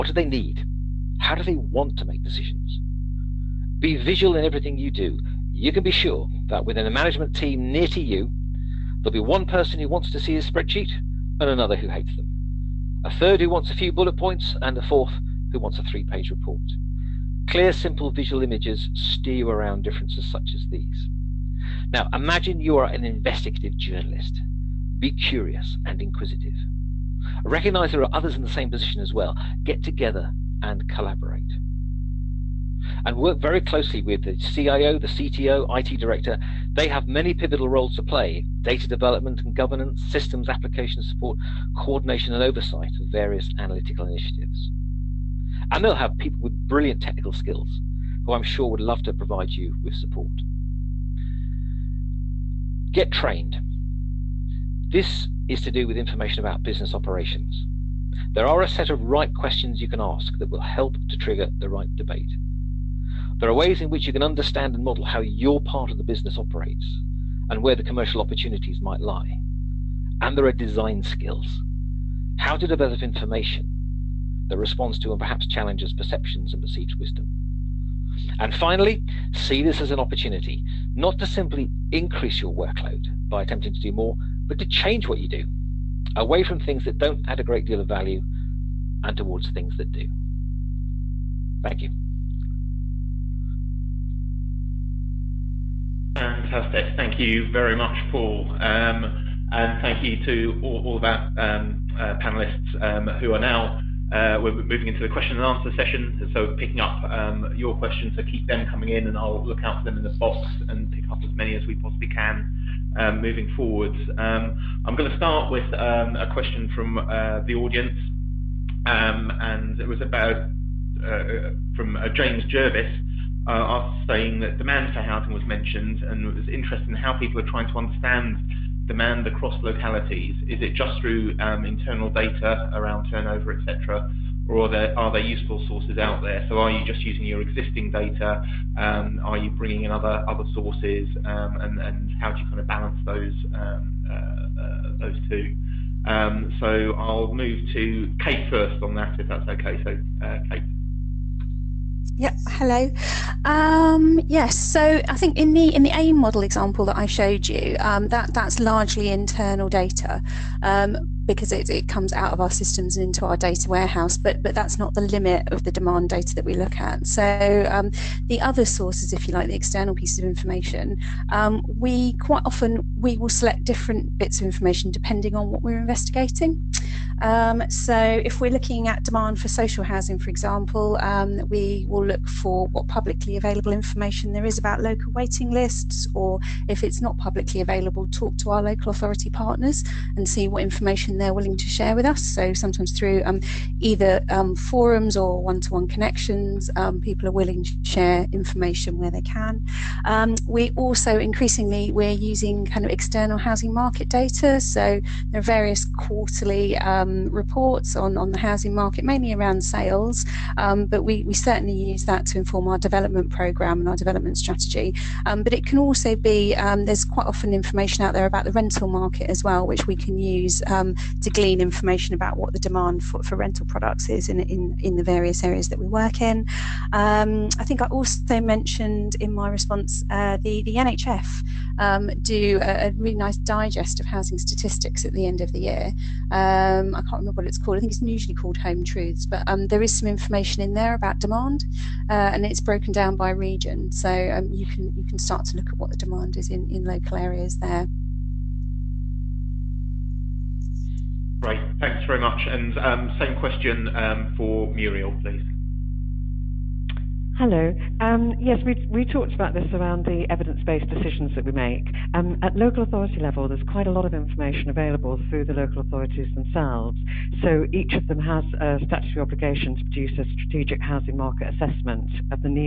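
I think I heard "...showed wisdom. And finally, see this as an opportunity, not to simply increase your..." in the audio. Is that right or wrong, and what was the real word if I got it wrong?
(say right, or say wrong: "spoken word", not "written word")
wrong: "perceived", not "showed".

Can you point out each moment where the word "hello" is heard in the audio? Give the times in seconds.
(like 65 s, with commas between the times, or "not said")
152 s, 257 s.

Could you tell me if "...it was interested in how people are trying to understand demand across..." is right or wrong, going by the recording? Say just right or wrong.
right.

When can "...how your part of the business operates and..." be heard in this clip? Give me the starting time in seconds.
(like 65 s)
65 s.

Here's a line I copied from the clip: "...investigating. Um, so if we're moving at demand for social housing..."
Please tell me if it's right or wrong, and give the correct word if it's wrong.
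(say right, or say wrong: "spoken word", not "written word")
wrong: "looking", not "moving".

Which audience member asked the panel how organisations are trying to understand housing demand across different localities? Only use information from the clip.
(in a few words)
James Jervis.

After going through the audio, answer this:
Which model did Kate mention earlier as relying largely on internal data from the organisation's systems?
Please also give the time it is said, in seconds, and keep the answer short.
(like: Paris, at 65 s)
AIM model, at 155 s.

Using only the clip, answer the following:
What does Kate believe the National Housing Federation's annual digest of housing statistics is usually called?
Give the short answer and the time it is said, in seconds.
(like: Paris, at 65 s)
Home Truths, at 238 s.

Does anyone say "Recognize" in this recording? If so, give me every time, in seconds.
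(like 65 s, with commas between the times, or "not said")
27 s.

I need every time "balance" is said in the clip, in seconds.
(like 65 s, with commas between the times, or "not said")
142 s.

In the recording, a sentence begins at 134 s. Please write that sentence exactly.
or are there, are there useful sources out there?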